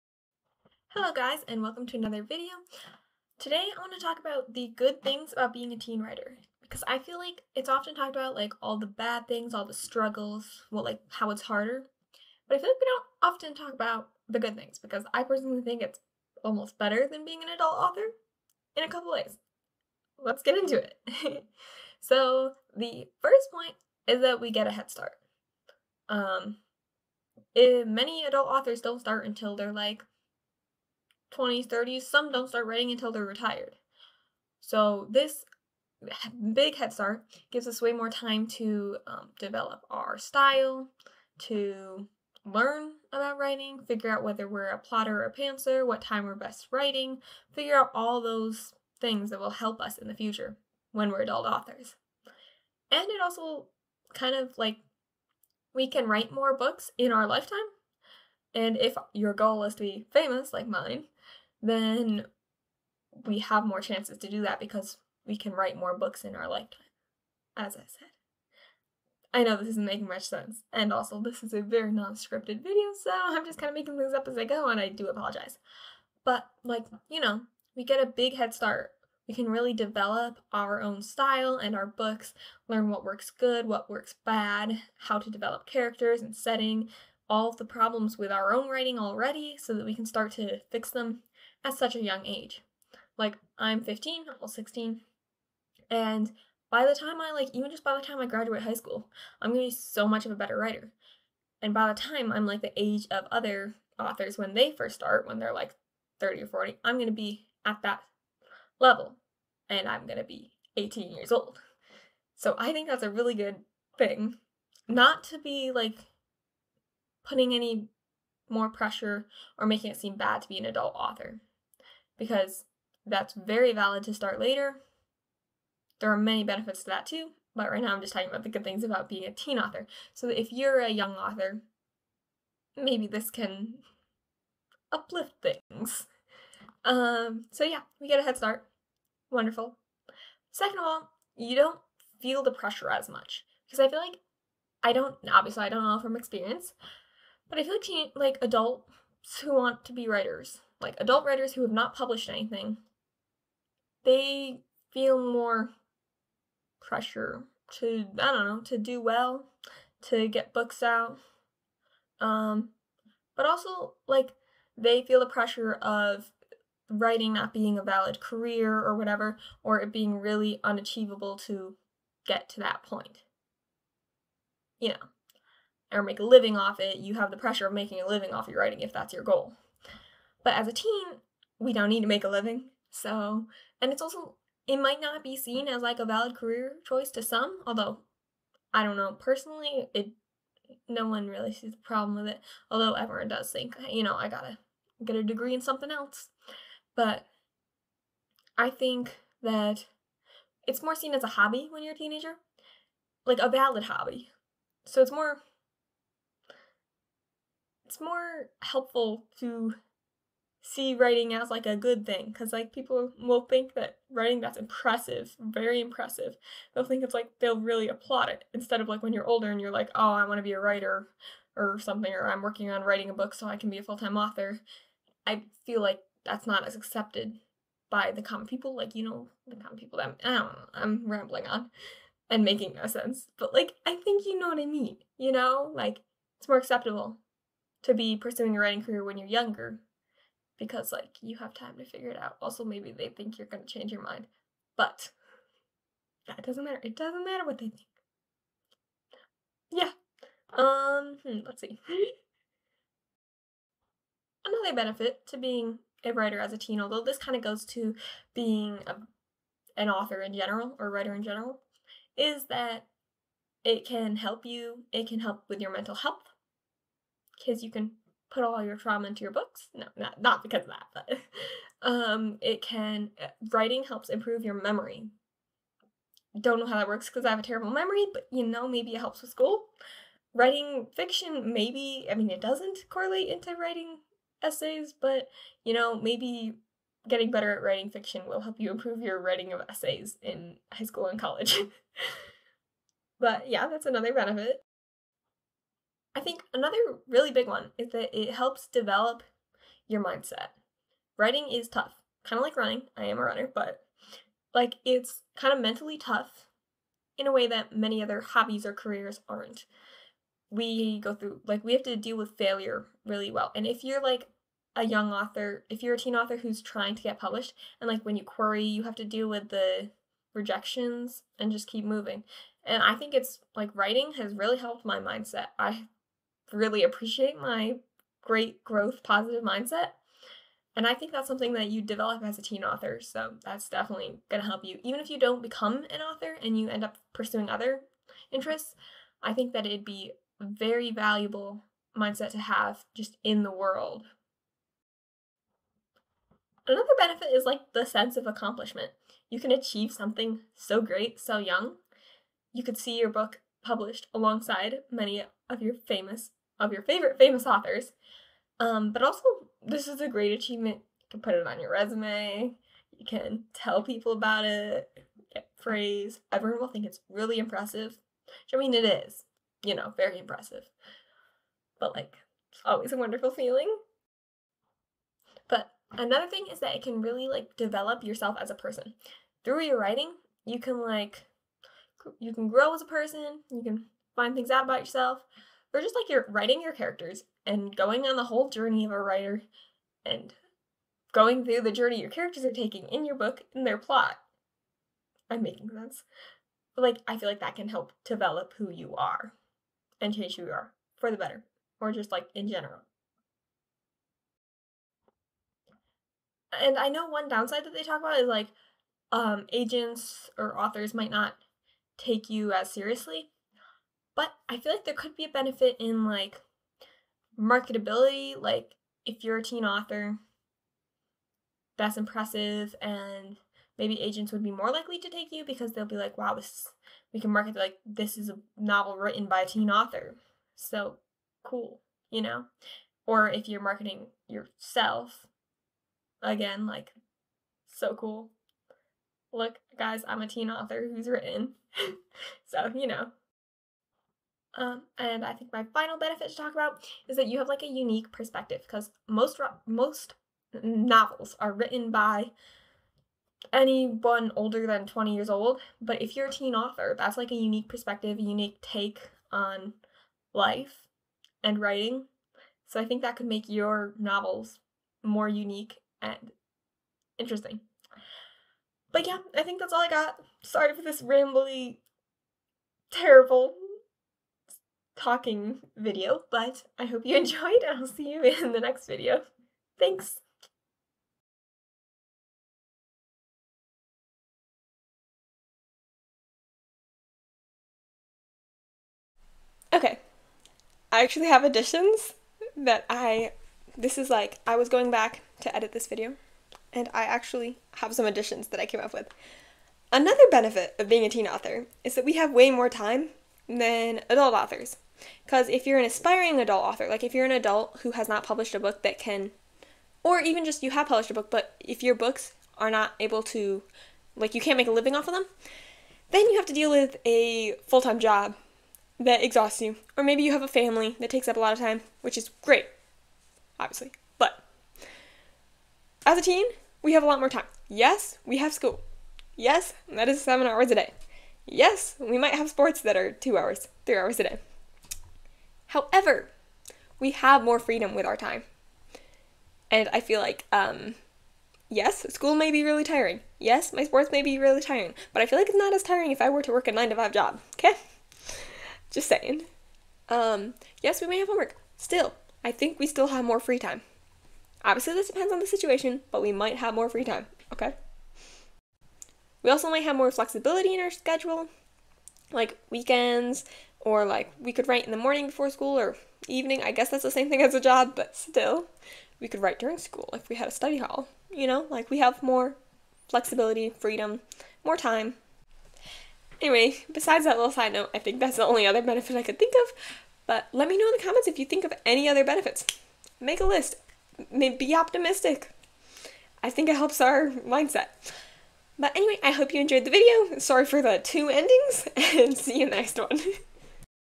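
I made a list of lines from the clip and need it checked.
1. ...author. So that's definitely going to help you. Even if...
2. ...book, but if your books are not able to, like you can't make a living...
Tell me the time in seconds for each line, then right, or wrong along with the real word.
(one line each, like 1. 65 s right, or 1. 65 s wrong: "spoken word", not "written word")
1. 332 s right
2. 511 s right.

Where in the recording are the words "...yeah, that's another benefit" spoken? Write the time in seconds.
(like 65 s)
293 s.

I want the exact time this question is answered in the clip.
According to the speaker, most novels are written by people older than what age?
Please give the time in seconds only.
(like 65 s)
454 s.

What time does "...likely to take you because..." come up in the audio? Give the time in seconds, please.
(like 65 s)
424 s.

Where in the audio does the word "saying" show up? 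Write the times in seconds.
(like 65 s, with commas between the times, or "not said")
549 s.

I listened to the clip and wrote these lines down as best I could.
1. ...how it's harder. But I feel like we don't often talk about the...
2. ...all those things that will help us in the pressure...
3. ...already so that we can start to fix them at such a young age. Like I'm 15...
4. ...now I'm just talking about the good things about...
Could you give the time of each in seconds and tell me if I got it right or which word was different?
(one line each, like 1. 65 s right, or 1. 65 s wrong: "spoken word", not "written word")
1. 11 s right
2. 47 s wrong: "future", not "pressure"
3. 88 s right
4. 127 s right.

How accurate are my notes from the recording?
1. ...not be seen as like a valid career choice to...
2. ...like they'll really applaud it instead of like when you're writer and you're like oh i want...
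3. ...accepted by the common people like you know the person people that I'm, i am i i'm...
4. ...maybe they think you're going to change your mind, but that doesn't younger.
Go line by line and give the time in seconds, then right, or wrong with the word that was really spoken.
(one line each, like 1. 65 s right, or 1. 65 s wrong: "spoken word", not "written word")
1. 185 s right
2. 217 s wrong: "older", not "writer"
3. 226 s wrong: "common", not "person"
4. 242 s wrong: "matter", not "younger".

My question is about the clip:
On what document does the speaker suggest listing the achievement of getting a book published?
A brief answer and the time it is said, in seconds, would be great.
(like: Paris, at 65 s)
resume, at 361 s.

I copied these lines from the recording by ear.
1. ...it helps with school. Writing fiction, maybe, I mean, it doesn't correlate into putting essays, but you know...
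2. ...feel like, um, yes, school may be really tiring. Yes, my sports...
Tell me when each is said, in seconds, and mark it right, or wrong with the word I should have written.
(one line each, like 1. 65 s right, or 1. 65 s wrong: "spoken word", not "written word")
1. 278 s wrong: "writing", not "putting"
2. 540 s right.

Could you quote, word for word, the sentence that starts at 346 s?
Another benefit is like the sense of accomplishment.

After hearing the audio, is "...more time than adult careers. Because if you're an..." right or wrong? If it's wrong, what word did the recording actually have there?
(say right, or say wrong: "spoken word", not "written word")
wrong: "authors", not "careers".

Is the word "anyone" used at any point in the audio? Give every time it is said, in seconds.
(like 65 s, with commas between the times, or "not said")
453 s.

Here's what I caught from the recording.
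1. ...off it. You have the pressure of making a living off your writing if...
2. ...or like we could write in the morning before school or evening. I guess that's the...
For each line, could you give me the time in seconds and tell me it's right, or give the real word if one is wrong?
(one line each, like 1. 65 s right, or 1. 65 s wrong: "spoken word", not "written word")
1. 176 s right
2. 563 s right.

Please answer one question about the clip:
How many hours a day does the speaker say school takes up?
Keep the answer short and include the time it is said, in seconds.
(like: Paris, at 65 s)
7, at 530 s.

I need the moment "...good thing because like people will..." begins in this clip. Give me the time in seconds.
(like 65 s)
211 s.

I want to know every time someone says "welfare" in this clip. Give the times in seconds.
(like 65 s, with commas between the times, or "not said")
not said.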